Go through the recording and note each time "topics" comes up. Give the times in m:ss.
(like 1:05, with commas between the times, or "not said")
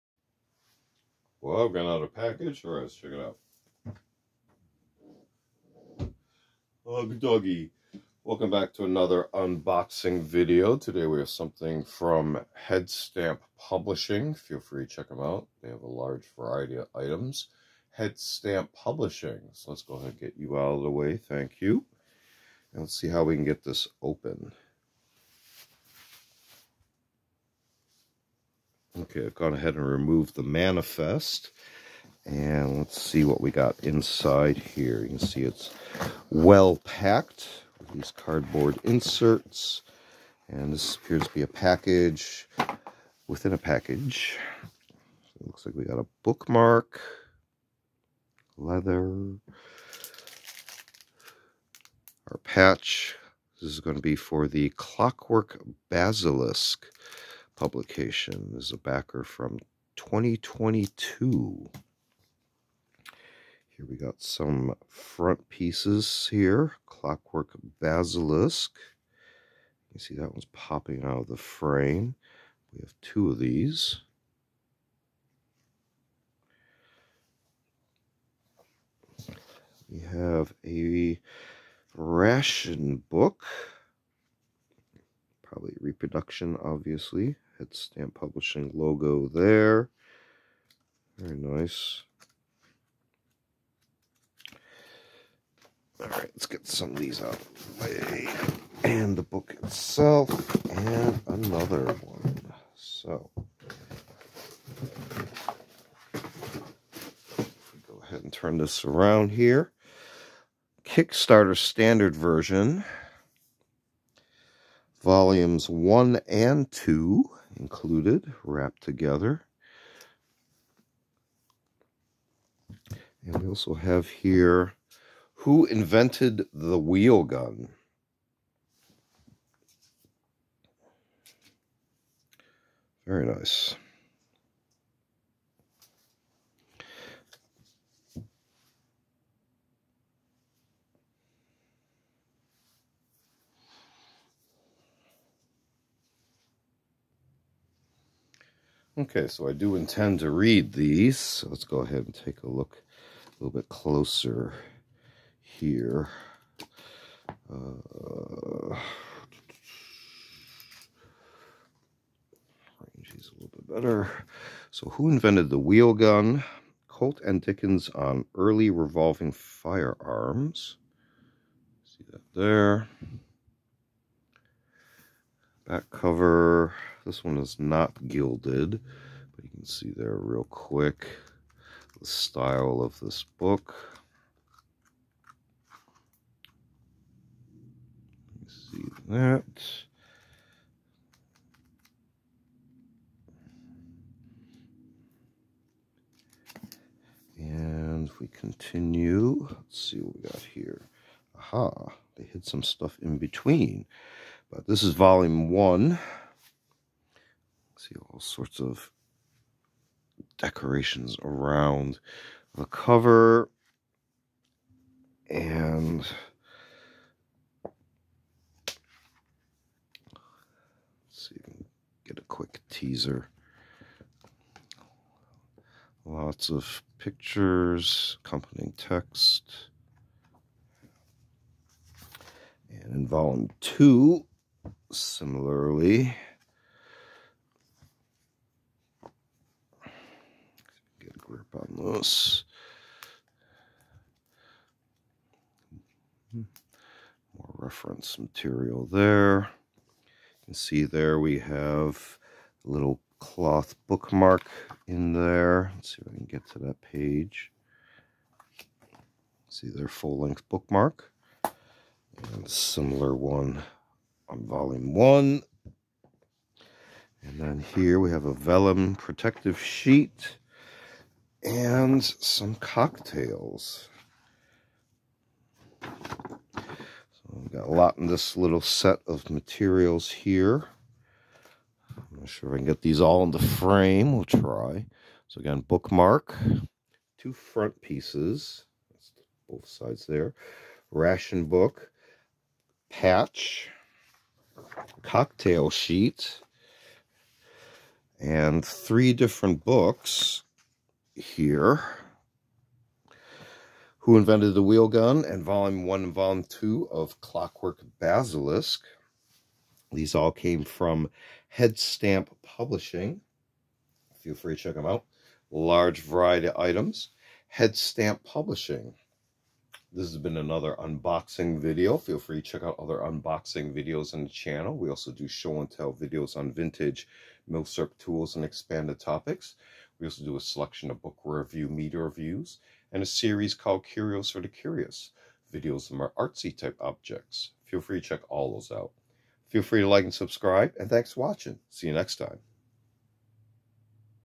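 5:28.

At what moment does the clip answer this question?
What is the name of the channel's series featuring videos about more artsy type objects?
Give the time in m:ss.
5:33.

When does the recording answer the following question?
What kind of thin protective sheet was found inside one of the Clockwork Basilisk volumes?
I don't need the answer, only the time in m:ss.
4:28.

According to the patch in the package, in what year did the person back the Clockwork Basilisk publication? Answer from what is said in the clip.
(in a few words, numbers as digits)
2022.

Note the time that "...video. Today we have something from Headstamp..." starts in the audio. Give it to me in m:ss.
0:10.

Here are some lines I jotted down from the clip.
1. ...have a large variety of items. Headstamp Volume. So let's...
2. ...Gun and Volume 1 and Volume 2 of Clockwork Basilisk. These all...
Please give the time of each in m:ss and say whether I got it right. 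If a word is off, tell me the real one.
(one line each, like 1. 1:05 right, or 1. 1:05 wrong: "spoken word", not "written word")
1. 0:15 wrong: "Publishing", not "Volume"
2. 5:04 right.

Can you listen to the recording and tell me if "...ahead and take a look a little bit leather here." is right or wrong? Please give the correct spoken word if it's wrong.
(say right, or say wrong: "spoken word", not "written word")
wrong: "closer", not "leather".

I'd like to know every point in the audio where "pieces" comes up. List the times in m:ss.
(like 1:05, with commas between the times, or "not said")
1:05, 4:47.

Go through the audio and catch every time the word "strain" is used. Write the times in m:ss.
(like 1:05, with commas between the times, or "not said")
not said.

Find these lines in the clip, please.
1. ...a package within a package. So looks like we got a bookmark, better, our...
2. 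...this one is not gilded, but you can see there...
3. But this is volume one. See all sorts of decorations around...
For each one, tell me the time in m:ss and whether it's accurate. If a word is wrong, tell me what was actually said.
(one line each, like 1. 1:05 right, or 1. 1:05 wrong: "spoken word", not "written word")
1. 0:41 wrong: "leather", not "better"
2. 2:57 right
3. 3:24 right.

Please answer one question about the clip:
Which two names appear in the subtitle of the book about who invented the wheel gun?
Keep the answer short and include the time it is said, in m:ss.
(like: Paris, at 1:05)
Colt and Dickens, at 2:46.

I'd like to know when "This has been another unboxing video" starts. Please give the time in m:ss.
5:19.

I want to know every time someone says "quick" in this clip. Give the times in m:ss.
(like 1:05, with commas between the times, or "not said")
3:00, 3:42.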